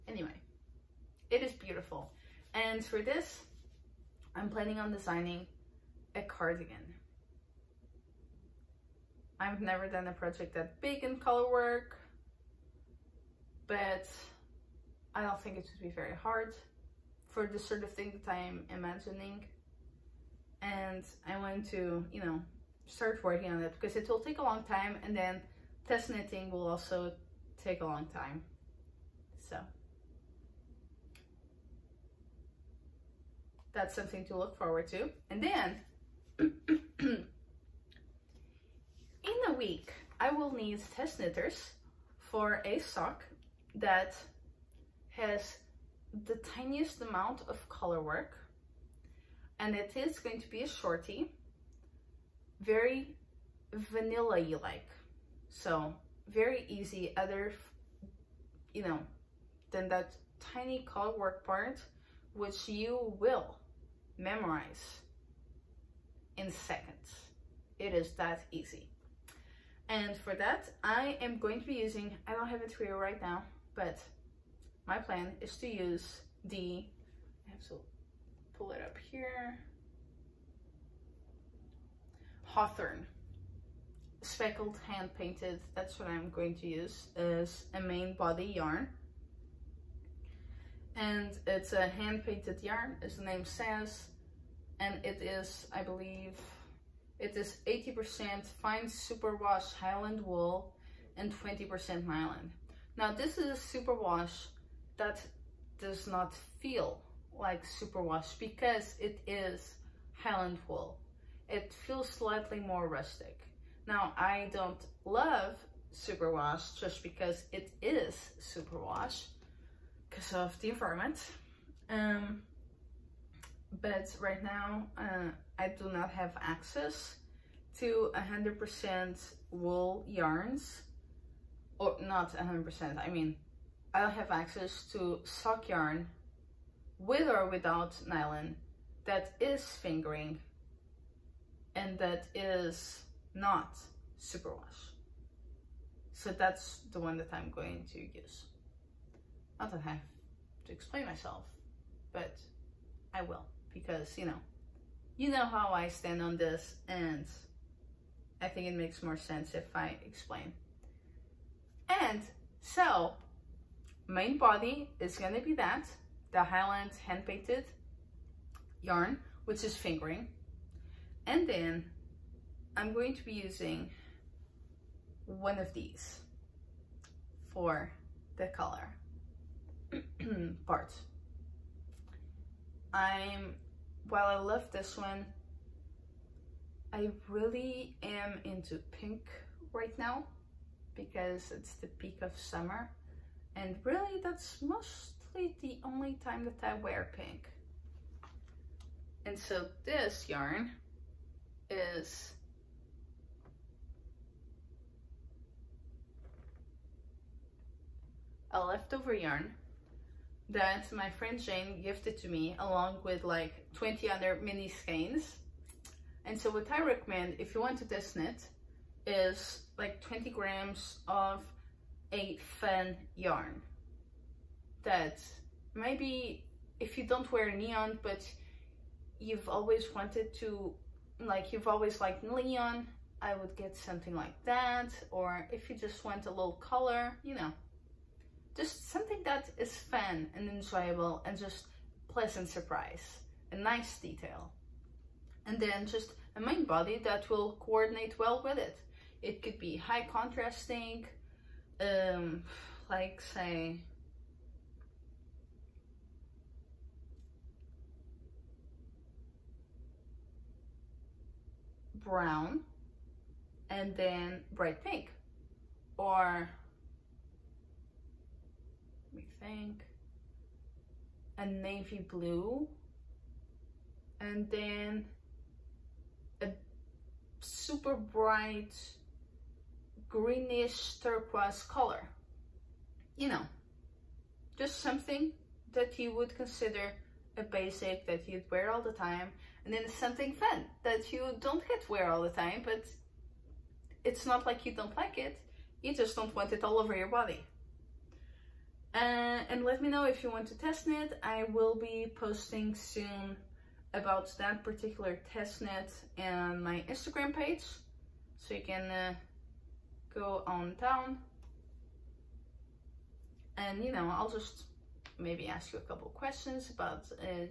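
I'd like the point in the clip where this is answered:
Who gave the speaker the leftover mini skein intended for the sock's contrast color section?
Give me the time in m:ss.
3:31.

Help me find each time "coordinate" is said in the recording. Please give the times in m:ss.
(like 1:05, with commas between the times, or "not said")
4:07.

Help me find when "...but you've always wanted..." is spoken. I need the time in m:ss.
3:48.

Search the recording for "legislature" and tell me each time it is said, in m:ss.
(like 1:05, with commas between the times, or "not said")
not said.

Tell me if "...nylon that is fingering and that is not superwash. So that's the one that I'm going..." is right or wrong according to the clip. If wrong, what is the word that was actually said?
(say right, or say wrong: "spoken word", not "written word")
right.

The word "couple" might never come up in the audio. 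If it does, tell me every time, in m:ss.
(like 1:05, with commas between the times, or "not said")
5:15.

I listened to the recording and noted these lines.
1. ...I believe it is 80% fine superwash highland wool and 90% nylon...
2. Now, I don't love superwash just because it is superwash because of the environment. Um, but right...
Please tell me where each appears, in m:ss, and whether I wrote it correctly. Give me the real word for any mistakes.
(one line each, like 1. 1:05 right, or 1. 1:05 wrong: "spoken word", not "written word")
1. 1:35 wrong: "20", not "90"
2. 1:53 right.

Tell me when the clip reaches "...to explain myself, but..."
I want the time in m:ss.
2:30.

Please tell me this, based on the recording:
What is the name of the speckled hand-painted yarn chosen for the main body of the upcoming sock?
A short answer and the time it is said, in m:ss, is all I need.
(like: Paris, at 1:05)
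Hawthorn, at 1:22.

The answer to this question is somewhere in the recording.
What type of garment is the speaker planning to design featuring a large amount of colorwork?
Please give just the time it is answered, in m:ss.
0:06.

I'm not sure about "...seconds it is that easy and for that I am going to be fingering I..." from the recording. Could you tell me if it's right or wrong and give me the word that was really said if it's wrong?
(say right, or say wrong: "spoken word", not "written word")
wrong: "using", not "fingering".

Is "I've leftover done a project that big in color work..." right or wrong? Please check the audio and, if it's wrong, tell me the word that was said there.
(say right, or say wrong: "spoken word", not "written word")
wrong: "never", not "leftover".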